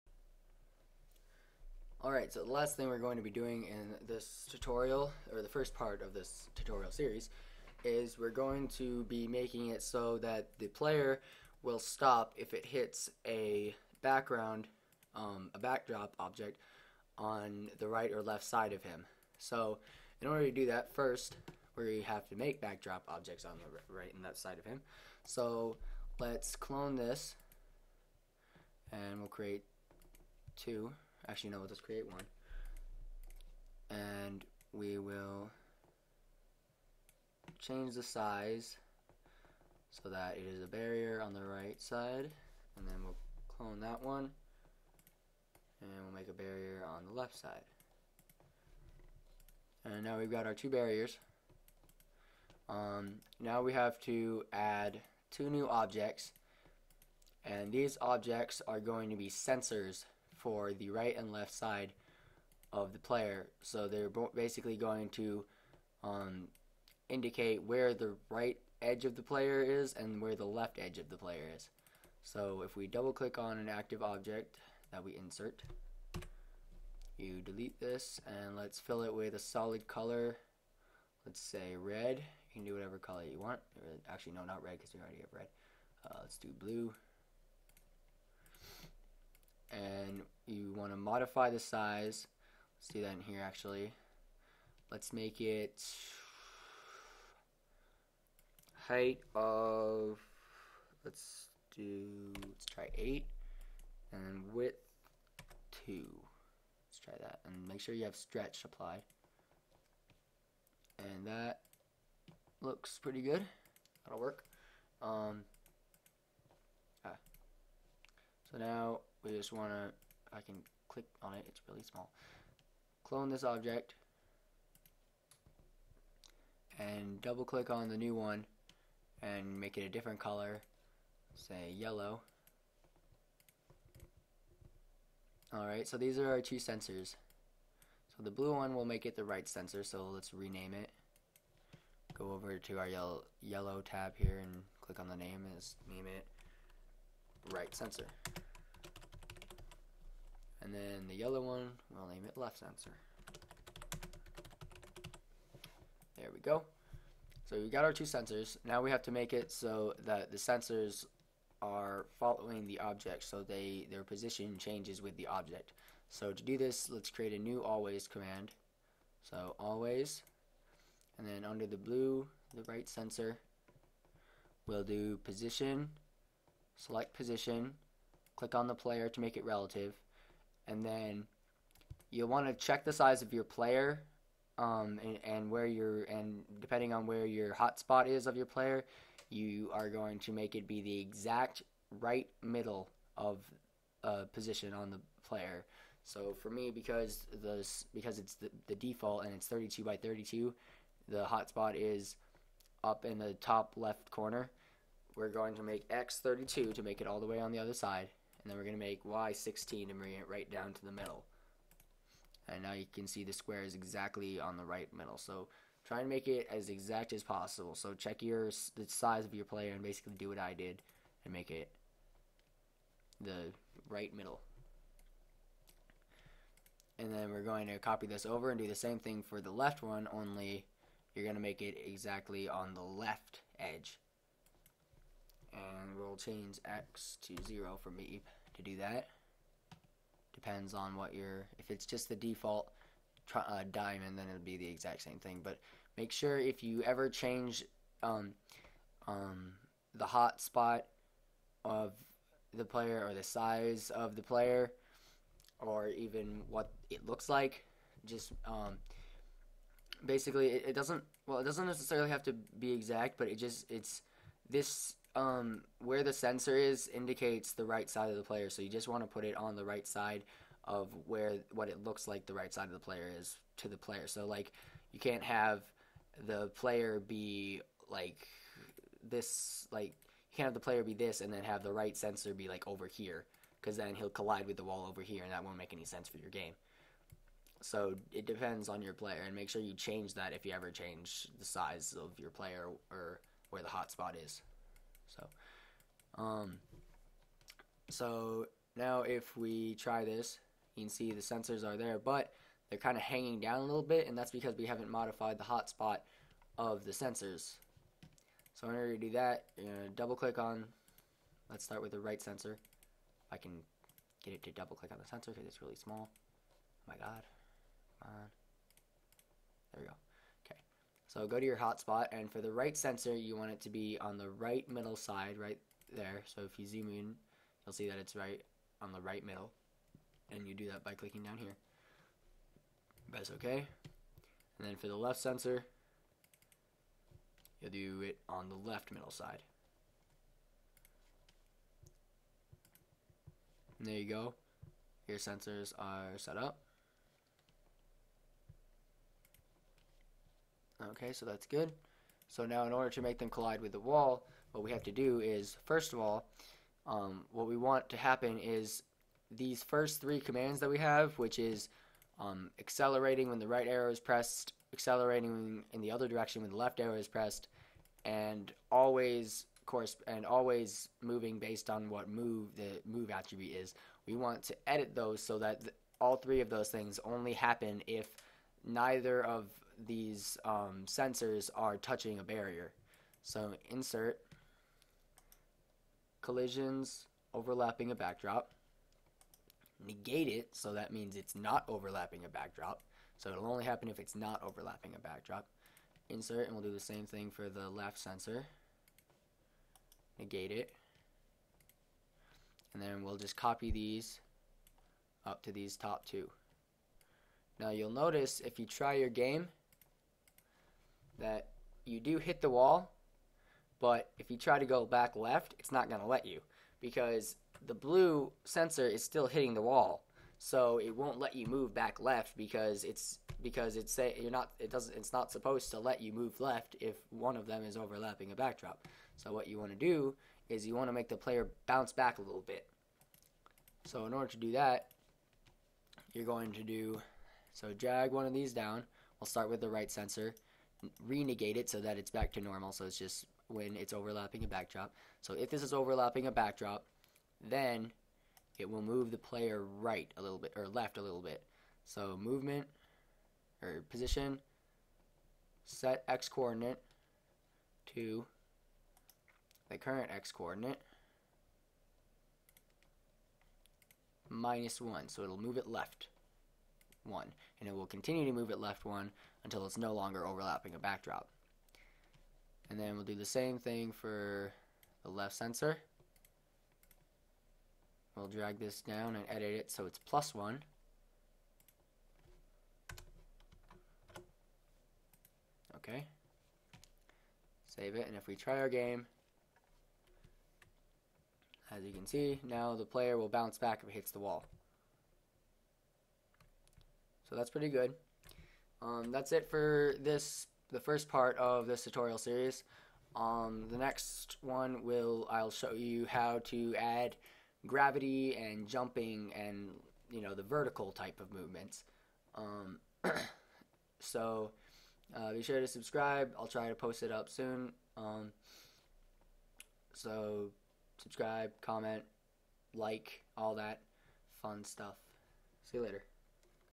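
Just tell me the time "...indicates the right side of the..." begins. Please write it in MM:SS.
04:26.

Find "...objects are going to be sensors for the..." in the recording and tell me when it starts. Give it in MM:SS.
00:57.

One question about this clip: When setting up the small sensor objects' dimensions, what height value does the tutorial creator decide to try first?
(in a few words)
8.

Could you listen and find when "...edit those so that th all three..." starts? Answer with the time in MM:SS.
06:14.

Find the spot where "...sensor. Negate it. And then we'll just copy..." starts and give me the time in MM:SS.
06:37.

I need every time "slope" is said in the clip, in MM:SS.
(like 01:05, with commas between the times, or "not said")
not said.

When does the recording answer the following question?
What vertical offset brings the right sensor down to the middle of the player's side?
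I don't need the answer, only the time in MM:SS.
03:29.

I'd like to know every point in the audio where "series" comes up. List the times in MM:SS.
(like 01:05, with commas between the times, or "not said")
00:06, 08:22.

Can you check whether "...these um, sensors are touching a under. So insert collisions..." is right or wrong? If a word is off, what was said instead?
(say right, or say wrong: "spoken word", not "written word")
wrong: "barrier", not "under".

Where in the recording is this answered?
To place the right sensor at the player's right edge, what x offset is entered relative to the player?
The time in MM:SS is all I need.
03:25.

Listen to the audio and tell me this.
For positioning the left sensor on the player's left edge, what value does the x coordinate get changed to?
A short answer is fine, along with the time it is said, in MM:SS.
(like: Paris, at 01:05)
0, at 03:56.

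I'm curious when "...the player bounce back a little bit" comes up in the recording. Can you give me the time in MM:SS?
07:11.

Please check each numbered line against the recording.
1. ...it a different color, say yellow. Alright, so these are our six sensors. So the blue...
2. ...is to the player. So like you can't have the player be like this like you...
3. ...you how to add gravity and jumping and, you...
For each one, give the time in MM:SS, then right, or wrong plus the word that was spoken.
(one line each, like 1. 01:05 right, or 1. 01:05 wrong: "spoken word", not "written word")
1. 02:09 wrong: "two", not "six"
2. 04:33 right
3. 08:25 right.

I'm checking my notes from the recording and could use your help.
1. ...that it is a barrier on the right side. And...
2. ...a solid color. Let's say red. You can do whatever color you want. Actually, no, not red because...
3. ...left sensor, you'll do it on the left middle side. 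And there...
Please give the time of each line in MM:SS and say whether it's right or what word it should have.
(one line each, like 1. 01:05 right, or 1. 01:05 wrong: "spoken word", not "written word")
1. 00:40 right
2. 01:19 right
3. 05:34 right.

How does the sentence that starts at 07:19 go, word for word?
We'll start with the right sensor, renegate it so that it's back to normal.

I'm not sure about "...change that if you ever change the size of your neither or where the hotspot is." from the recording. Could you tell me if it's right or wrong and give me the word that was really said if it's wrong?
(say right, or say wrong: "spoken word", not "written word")
wrong: "player", not "neither".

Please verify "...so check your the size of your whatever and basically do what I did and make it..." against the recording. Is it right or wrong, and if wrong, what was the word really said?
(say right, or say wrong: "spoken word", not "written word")
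wrong: "player", not "whatever".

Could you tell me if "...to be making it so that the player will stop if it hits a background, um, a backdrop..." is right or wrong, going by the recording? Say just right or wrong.
right.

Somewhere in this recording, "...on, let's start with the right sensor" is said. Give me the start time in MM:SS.
05:10.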